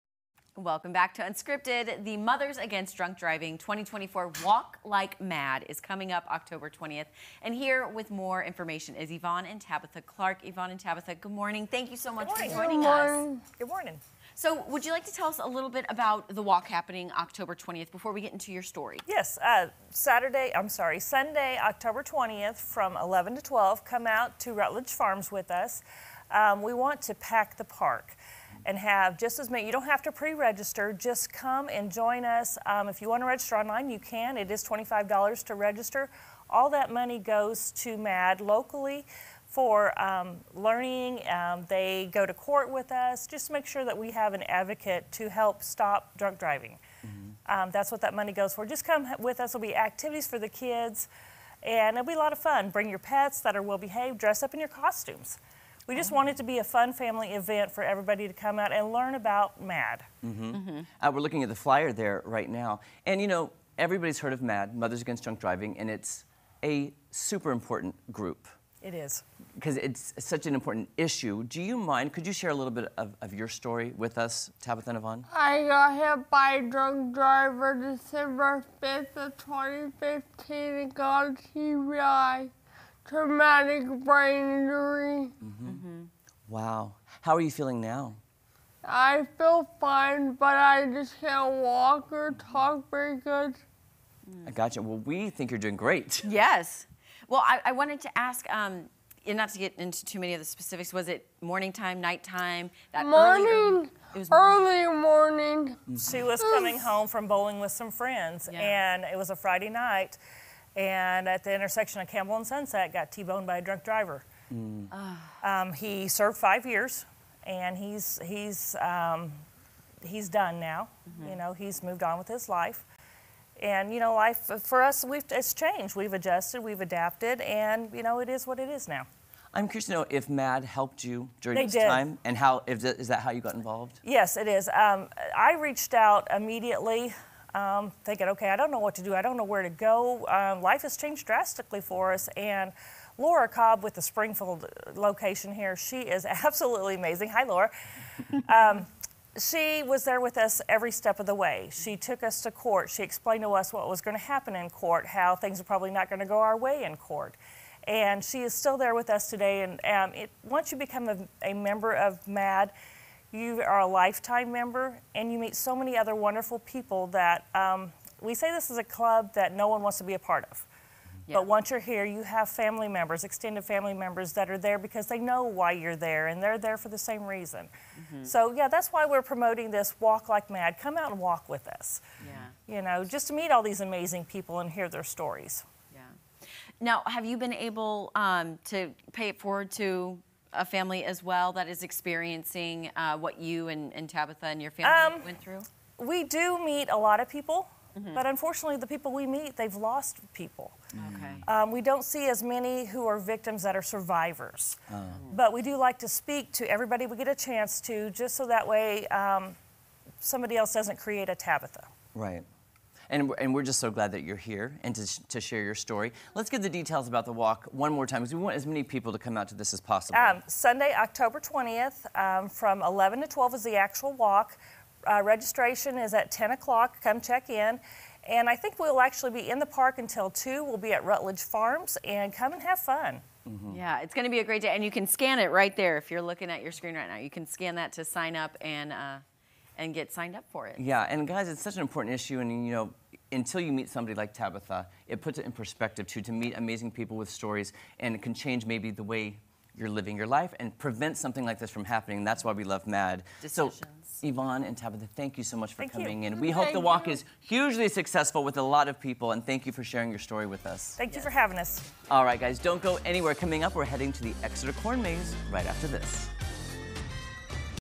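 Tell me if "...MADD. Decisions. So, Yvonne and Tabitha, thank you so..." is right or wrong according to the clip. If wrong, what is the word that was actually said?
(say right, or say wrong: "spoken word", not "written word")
right.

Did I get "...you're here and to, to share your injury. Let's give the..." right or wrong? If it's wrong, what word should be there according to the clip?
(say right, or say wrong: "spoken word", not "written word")
wrong: "story", not "injury".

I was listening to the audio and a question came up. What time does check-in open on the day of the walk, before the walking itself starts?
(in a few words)
10 o'clock.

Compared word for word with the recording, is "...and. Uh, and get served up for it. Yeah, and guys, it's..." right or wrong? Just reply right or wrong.
wrong.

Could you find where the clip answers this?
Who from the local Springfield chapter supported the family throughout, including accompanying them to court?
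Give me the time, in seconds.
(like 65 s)
143 s.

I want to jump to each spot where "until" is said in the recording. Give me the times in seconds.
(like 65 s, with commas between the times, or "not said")
229 s, 243 s.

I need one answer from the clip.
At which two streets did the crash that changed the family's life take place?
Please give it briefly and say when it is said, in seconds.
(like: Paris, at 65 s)
Campbell and Sunset, at 112 s.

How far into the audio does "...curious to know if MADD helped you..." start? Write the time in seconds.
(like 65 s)
129 s.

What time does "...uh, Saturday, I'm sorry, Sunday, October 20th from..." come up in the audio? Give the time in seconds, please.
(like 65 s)
19 s.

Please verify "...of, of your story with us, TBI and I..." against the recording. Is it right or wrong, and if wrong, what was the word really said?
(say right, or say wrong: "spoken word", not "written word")
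wrong: "Tabitha", not "TBI".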